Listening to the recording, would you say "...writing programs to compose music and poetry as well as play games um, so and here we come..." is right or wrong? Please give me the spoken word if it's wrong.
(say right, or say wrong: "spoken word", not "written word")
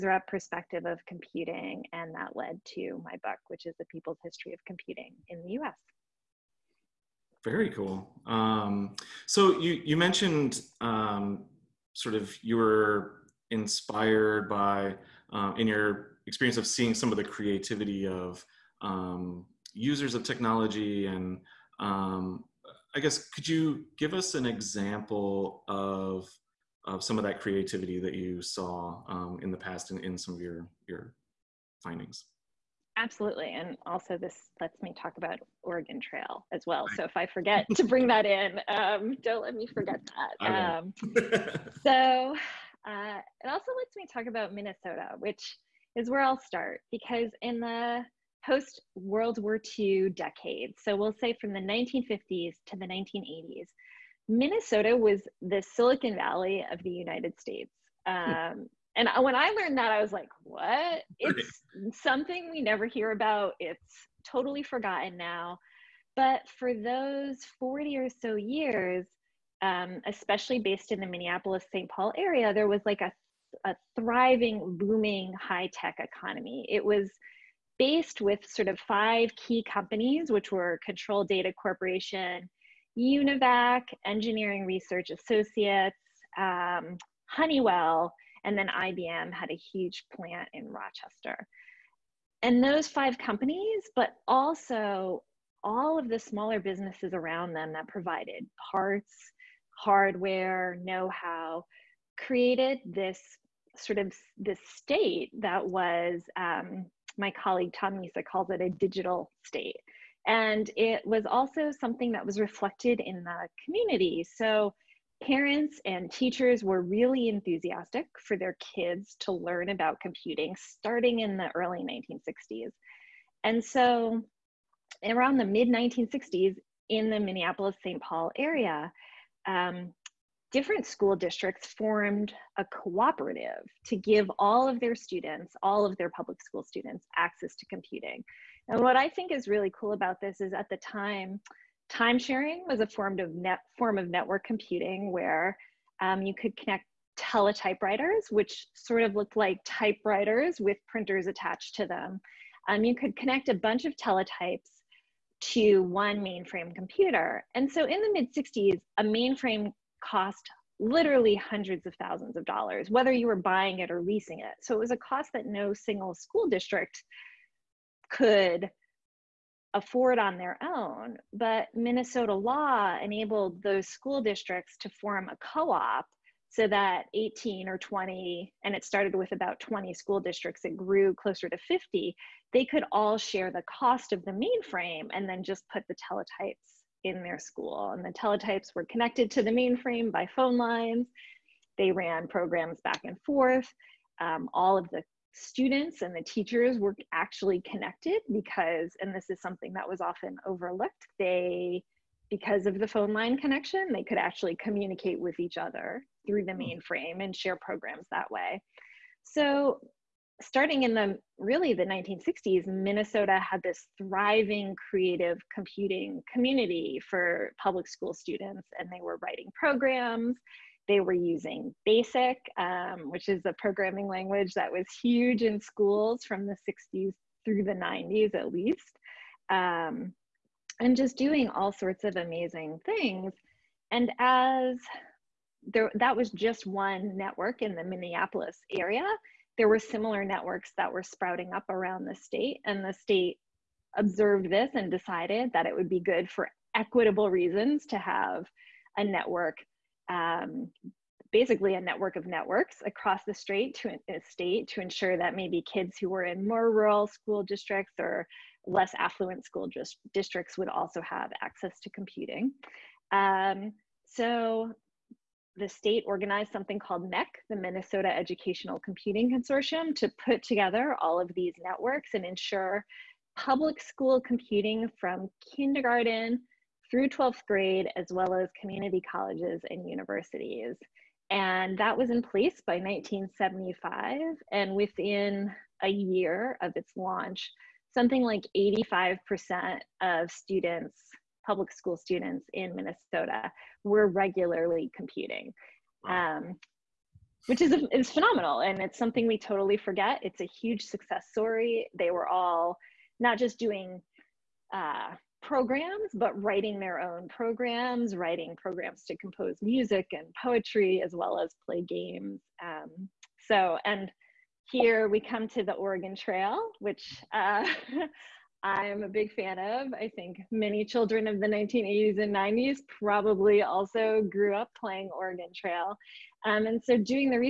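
right.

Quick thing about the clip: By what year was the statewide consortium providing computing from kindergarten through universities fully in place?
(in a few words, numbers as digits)
1975.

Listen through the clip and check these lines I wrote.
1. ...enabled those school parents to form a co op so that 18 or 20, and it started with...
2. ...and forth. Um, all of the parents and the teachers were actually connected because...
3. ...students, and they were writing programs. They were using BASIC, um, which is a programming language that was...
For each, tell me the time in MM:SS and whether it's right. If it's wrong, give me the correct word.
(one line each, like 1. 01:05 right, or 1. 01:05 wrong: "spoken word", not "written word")
1. 02:53 wrong: "districts", not "parents"
2. 03:13 wrong: "students", not "parents"
3. 03:38 right.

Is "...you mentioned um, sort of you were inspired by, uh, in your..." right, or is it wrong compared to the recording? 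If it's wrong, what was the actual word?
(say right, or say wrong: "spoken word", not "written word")
right.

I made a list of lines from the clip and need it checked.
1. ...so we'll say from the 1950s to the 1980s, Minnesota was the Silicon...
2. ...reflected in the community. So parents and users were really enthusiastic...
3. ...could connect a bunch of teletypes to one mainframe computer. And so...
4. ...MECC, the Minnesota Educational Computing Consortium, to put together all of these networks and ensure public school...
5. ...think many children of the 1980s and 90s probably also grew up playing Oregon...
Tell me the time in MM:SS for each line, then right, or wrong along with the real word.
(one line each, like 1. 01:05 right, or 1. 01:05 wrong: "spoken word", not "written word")
1. 00:50 right
2. 01:52 wrong: "teachers", not "users"
3. 02:32 right
4. 04:27 right
5. 05:20 right.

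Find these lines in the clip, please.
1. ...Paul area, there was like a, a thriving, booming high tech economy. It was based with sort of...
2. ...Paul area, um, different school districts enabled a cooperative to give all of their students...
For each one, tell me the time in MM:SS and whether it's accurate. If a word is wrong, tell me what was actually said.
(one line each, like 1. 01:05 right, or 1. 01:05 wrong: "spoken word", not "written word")
1. 01:11 right
2. 02:08 wrong: "formed", not "enabled".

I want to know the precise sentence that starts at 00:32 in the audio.
Absolutely, and also this lets me talk about Oregon Trail as well.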